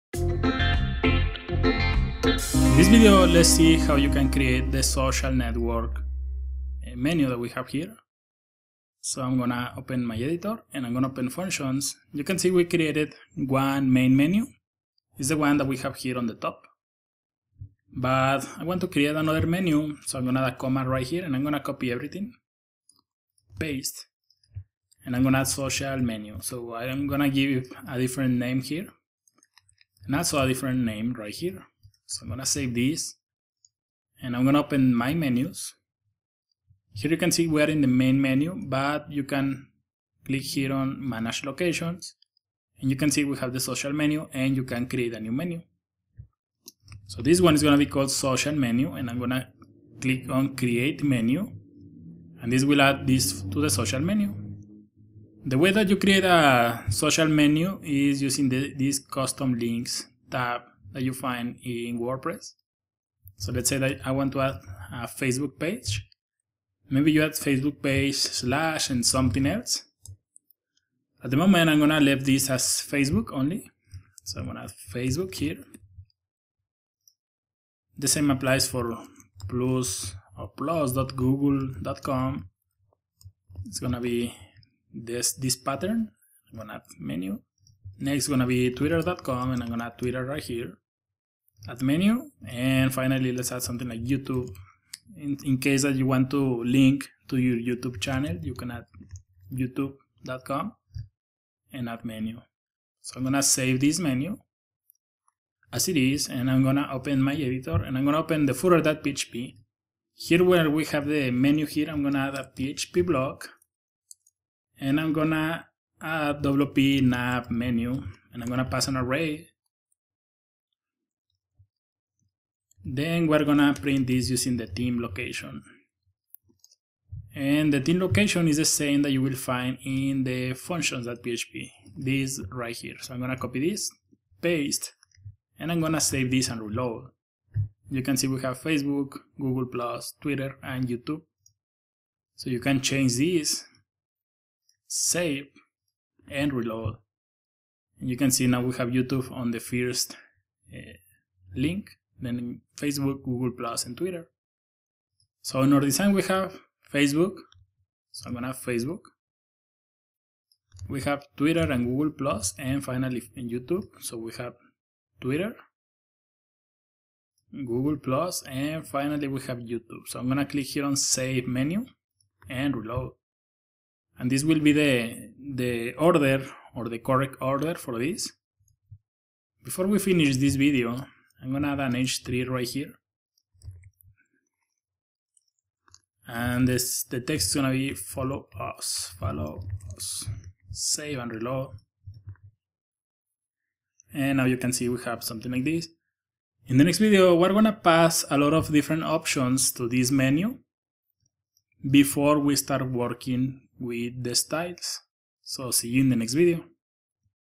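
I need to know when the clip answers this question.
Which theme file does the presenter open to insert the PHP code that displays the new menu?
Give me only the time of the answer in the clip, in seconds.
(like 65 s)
108 s.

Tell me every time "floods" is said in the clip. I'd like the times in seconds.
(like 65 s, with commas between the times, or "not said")
not said.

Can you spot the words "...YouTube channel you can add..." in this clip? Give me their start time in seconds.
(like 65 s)
97 s.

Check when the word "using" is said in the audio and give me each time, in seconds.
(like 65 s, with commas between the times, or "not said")
58 s, 124 s.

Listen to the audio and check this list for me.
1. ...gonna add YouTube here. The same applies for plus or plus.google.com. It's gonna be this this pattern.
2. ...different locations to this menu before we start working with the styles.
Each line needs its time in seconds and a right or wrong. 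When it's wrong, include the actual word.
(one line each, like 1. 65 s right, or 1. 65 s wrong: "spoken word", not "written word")
1. 74 s wrong: "Facebook", not "YouTube"
2. 198 s wrong: "options", not "locations".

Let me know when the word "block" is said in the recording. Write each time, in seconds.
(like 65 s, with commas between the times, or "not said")
113 s.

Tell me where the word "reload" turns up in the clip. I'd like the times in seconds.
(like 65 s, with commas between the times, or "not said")
136 s, 146 s, 172 s, 191 s.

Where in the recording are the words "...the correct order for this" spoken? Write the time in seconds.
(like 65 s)
176 s.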